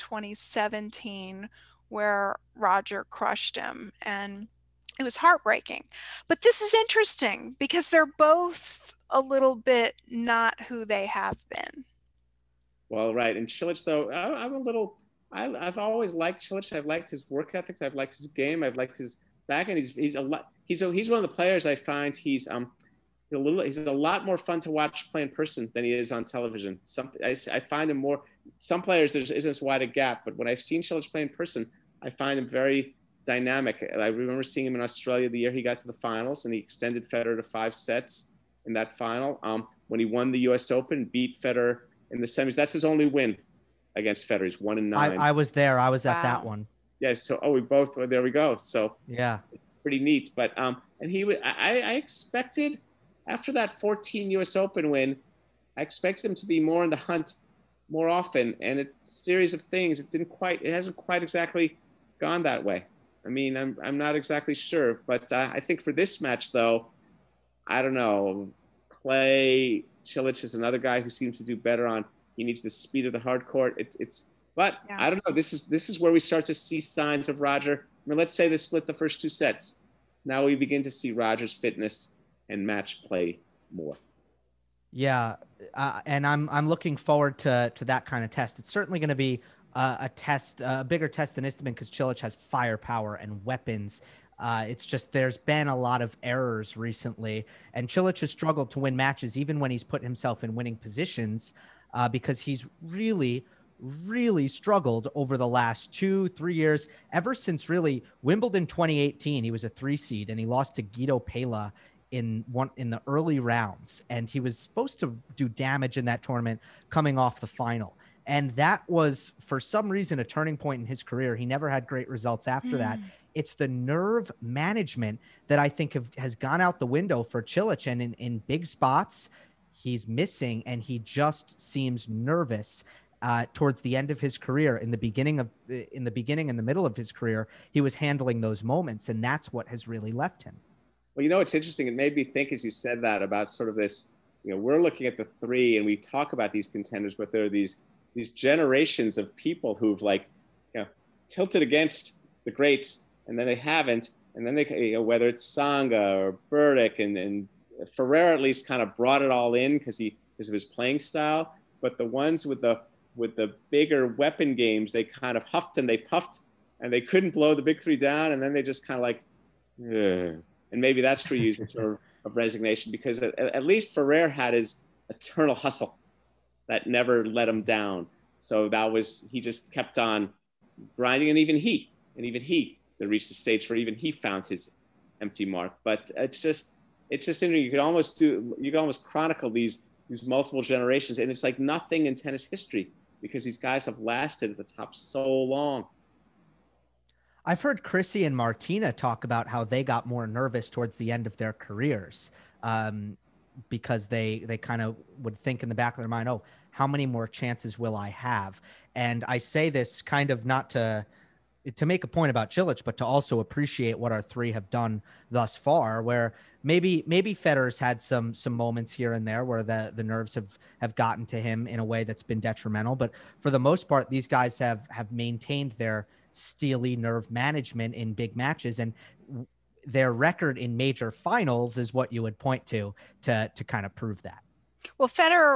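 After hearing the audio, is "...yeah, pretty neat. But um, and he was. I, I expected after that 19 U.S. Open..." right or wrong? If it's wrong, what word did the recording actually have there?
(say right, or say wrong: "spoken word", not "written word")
wrong: "14", not "19".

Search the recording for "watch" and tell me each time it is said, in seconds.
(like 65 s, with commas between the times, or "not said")
24 s.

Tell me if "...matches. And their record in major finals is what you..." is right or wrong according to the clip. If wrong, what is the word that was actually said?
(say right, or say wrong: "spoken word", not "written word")
right.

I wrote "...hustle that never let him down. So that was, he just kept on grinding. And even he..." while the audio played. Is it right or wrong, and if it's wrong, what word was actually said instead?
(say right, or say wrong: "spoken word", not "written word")
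right.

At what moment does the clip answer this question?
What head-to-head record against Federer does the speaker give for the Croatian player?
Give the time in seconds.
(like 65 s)
44 s.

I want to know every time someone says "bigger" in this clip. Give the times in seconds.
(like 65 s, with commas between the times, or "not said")
90 s, 163 s.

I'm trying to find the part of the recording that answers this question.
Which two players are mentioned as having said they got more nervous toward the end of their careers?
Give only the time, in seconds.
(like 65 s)
197 s.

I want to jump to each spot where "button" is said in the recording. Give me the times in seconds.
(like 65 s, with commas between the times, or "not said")
not said.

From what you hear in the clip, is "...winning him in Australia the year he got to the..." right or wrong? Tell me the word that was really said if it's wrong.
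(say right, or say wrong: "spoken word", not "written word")
wrong: "seeing", not "winning".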